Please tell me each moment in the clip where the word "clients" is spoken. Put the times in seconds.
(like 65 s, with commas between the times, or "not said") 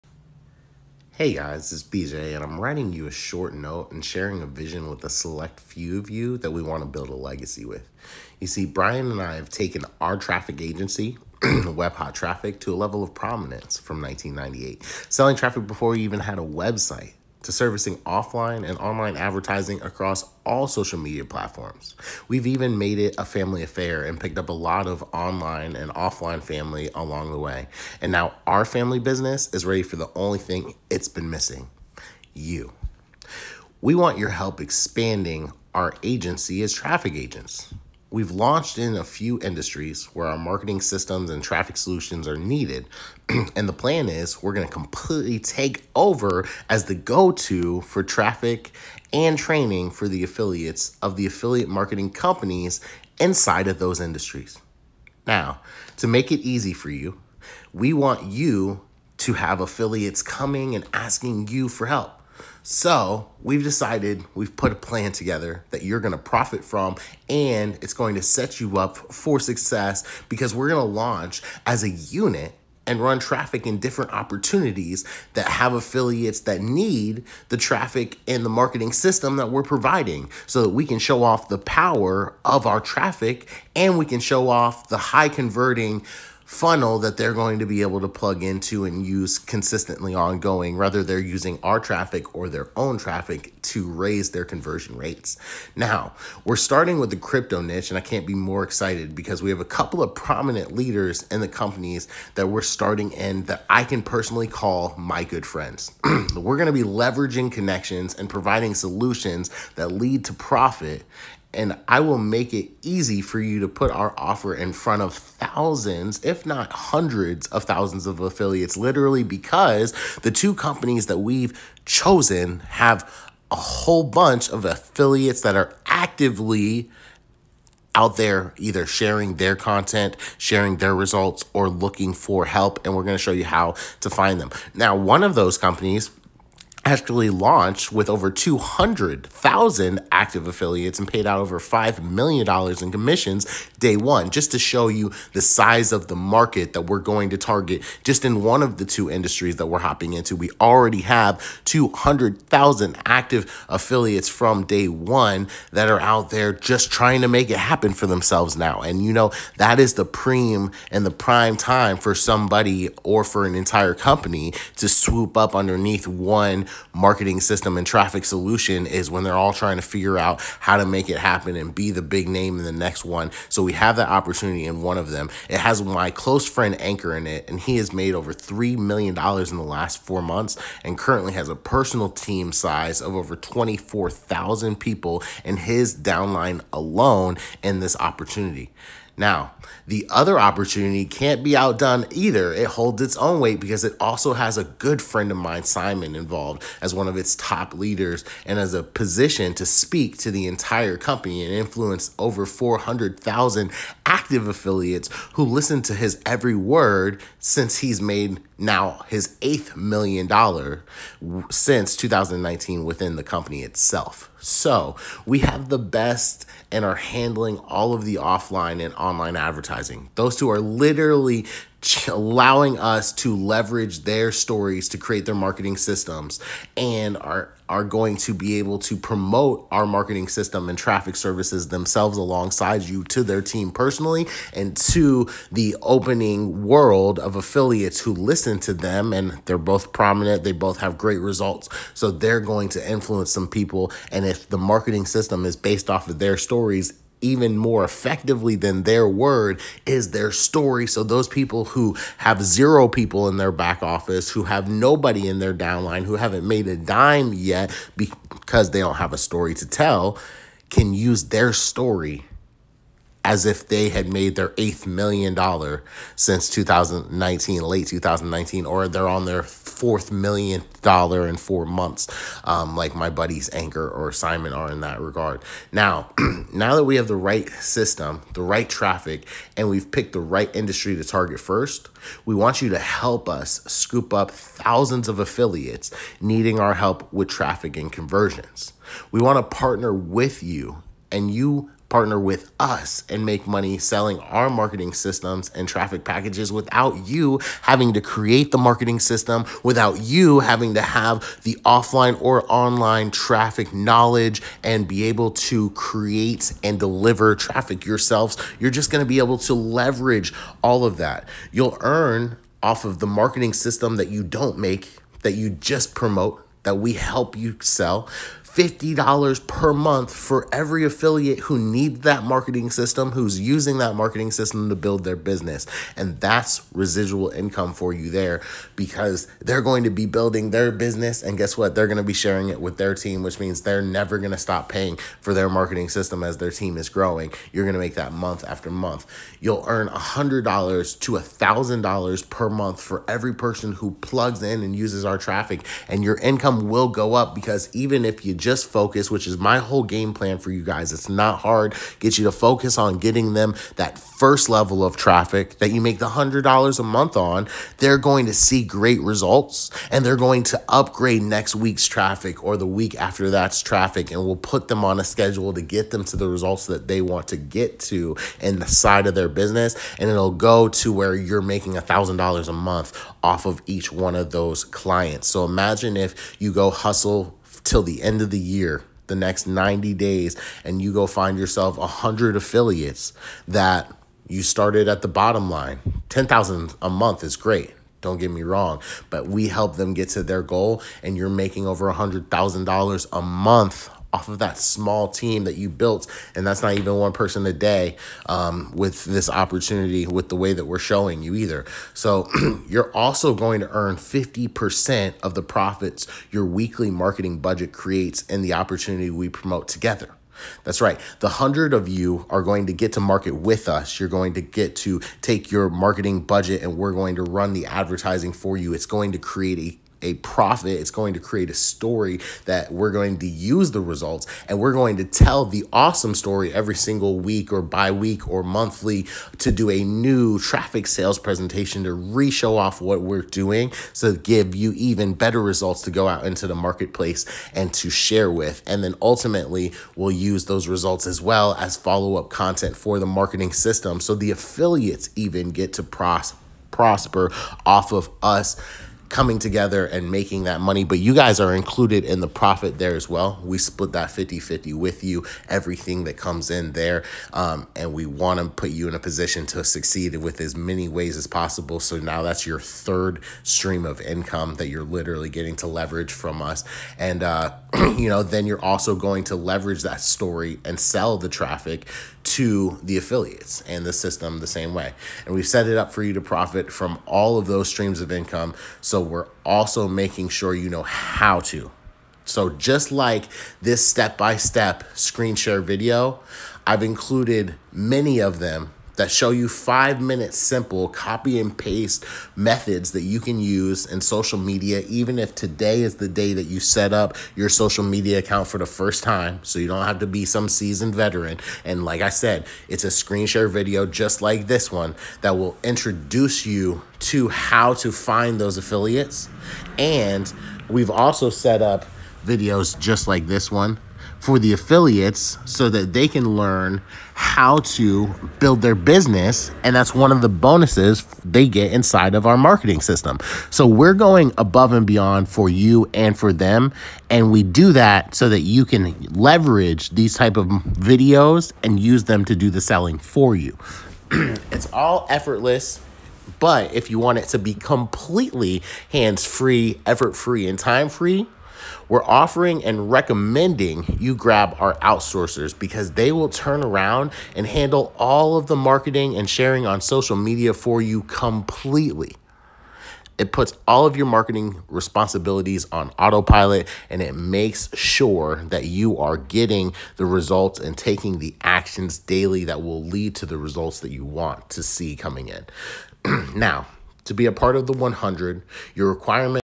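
374 s.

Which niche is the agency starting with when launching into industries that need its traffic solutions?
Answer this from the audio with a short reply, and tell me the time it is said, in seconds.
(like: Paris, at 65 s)
crypto, at 97 s.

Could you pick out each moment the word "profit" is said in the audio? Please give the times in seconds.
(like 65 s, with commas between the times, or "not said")
66 s, 110 s, 405 s, 420 s, 452 s, 476 s.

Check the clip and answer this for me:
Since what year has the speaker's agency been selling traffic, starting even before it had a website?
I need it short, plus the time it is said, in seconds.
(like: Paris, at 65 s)
1998, at 14 s.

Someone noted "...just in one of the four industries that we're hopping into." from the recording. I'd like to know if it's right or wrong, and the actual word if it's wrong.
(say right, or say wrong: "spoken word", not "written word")
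wrong: "two", not "four".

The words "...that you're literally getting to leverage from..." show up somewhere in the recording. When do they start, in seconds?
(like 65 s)
464 s.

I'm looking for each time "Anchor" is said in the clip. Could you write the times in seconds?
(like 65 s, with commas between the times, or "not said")
176 s, 273 s.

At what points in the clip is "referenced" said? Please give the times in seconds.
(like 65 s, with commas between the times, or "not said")
not said.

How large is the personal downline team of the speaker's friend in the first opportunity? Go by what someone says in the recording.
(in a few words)
over 24,000.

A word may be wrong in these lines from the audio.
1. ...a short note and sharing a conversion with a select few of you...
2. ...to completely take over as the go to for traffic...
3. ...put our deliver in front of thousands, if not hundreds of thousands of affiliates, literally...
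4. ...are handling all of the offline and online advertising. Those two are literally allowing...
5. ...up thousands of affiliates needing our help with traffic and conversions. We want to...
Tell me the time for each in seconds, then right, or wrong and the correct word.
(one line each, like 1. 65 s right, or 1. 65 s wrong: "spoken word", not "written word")
1. 3 s wrong: "vision", not "conversion"
2. 44 s right
3. 113 s wrong: "offer", not "deliver"
4. 216 s right
5. 284 s right.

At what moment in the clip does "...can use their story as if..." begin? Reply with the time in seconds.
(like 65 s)
260 s.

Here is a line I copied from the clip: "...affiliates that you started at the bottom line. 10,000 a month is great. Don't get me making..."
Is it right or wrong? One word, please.
wrong.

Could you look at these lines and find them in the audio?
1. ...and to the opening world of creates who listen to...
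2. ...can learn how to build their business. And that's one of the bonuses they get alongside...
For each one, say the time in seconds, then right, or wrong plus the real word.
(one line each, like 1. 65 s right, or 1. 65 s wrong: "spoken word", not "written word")
1. 234 s wrong: "affiliates", not "creates"
2. 516 s wrong: "inside", not "alongside".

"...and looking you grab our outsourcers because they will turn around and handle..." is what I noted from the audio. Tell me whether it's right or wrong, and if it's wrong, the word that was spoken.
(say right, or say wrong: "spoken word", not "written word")
wrong: "recommending", not "looking".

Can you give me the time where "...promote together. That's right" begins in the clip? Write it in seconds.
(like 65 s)
409 s.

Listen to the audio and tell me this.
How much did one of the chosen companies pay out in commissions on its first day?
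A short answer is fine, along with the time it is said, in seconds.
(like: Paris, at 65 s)
$5 million, at 141 s.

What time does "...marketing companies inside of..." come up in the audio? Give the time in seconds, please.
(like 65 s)
51 s.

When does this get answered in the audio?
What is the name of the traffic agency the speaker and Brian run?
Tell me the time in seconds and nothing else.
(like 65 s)
11 s.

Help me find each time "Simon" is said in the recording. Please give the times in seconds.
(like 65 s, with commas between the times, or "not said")
195 s, 274 s.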